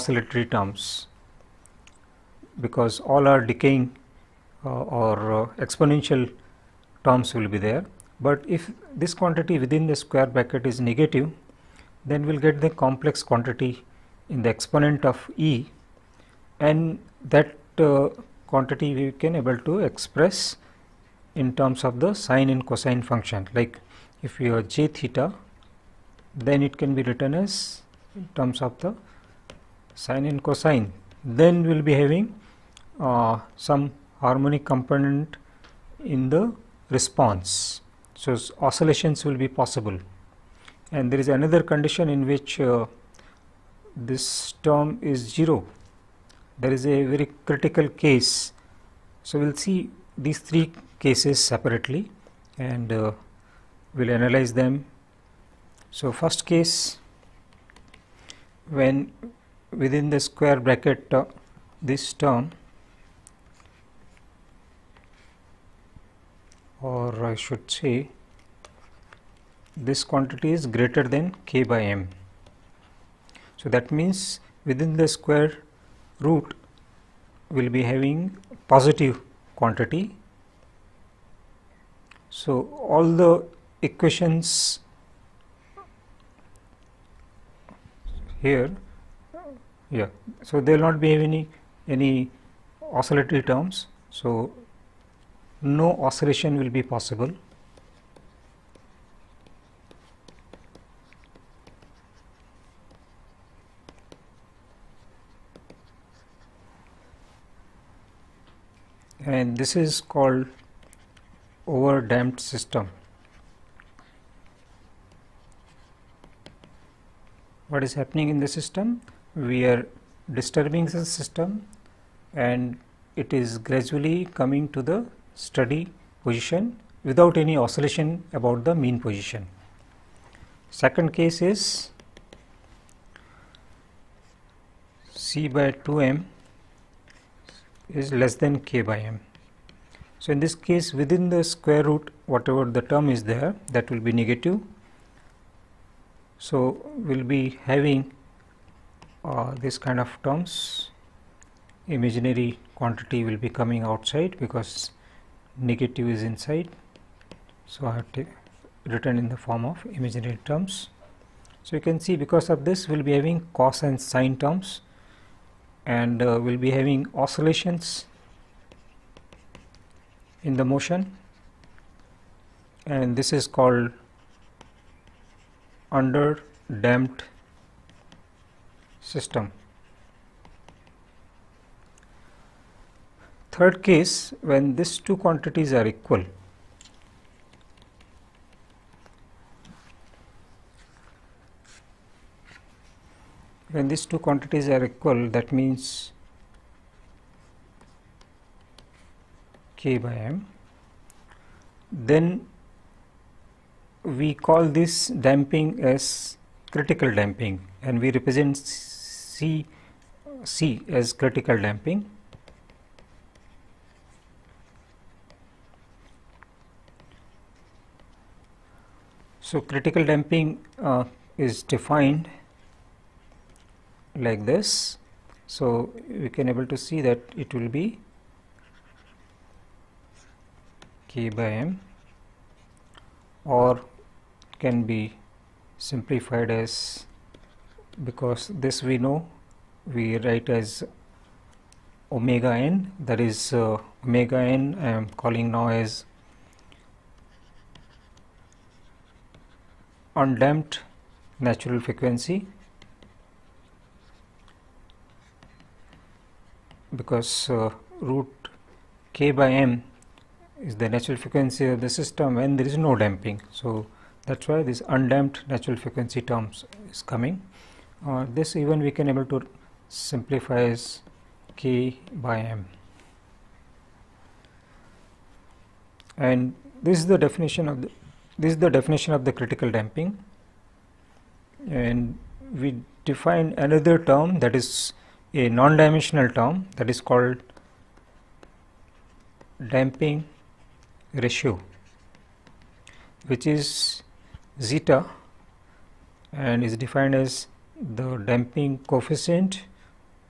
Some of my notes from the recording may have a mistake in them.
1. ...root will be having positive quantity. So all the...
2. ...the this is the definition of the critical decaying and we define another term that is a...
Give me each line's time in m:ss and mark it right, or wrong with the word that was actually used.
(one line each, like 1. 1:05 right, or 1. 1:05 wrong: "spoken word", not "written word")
1. 1:16 right
2. 4:37 wrong: "damping", not "decaying".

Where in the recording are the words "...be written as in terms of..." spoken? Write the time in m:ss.
0:26.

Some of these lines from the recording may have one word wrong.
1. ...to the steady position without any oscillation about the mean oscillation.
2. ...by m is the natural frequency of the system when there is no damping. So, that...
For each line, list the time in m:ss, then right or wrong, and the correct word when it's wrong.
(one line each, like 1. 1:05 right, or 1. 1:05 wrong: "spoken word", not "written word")
1. 2:04 wrong: "position", not "oscillation"
2. 4:19 right.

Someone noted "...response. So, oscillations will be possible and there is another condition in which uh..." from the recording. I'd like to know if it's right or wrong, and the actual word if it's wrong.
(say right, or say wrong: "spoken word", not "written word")
right.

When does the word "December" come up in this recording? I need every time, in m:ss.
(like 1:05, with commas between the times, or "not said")
not said.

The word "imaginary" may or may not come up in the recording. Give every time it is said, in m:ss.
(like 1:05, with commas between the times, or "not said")
2:31, 2:39.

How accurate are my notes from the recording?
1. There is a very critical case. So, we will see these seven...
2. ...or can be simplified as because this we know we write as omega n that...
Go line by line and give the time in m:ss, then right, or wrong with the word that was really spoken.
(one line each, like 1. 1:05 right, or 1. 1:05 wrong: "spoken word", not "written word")
1. 0:46 wrong: "three", not "seven"
2. 3:53 right.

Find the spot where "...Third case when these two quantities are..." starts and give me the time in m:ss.
3:03.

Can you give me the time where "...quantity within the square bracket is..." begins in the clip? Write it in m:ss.
0:09.